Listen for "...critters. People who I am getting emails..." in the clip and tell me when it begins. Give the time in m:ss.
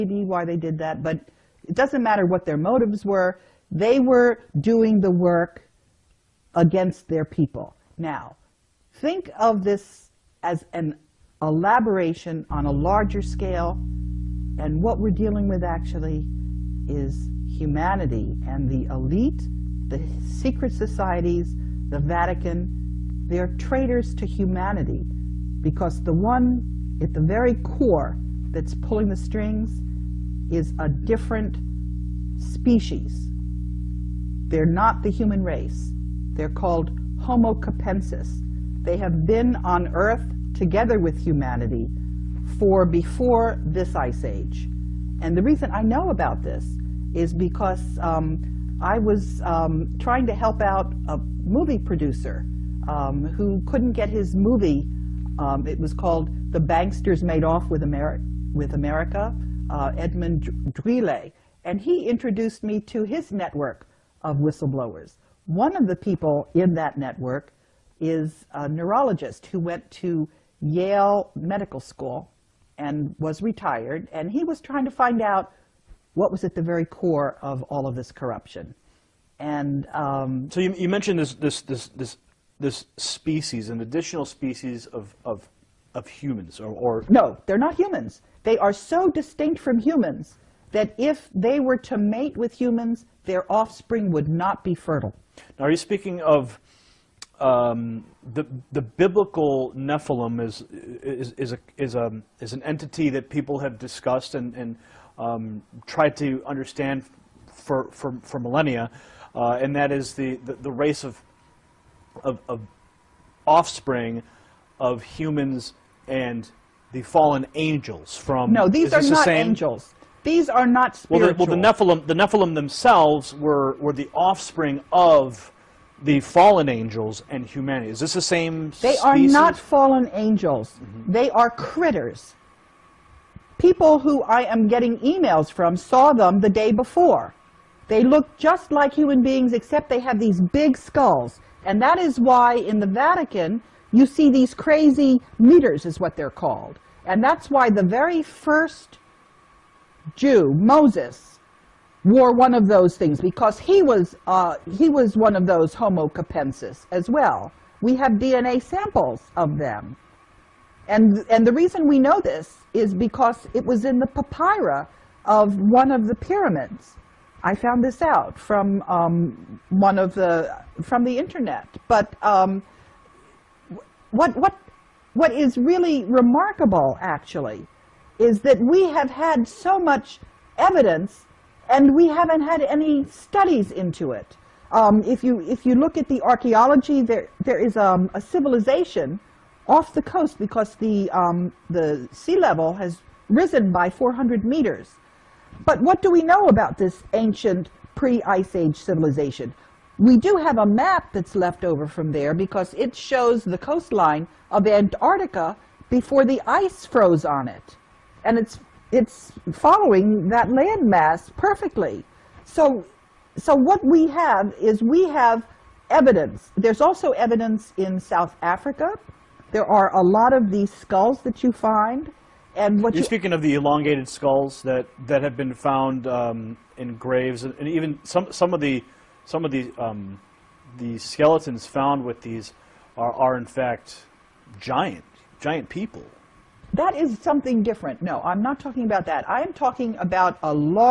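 2:11.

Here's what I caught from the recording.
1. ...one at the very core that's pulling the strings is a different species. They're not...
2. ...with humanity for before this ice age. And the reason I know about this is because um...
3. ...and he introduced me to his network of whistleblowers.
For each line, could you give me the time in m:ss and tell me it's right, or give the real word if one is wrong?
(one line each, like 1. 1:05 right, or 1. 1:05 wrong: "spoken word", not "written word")
1. 0:26 right
2. 0:40 right
3. 1:01 right.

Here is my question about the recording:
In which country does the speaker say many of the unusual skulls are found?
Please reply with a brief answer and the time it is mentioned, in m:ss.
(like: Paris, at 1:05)
South Africa, at 3:37.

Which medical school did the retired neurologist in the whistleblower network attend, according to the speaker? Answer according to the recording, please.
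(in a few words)
Yale Medical School.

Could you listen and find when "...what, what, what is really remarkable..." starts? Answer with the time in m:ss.
2:54.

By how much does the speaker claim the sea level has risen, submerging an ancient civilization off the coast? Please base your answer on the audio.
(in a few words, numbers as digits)
400 meters.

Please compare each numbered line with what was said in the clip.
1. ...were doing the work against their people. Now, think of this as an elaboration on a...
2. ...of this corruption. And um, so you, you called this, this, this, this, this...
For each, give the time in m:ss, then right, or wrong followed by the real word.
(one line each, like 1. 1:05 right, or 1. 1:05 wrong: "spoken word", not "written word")
1. 0:03 right
2. 1:17 wrong: "mentioned", not "called".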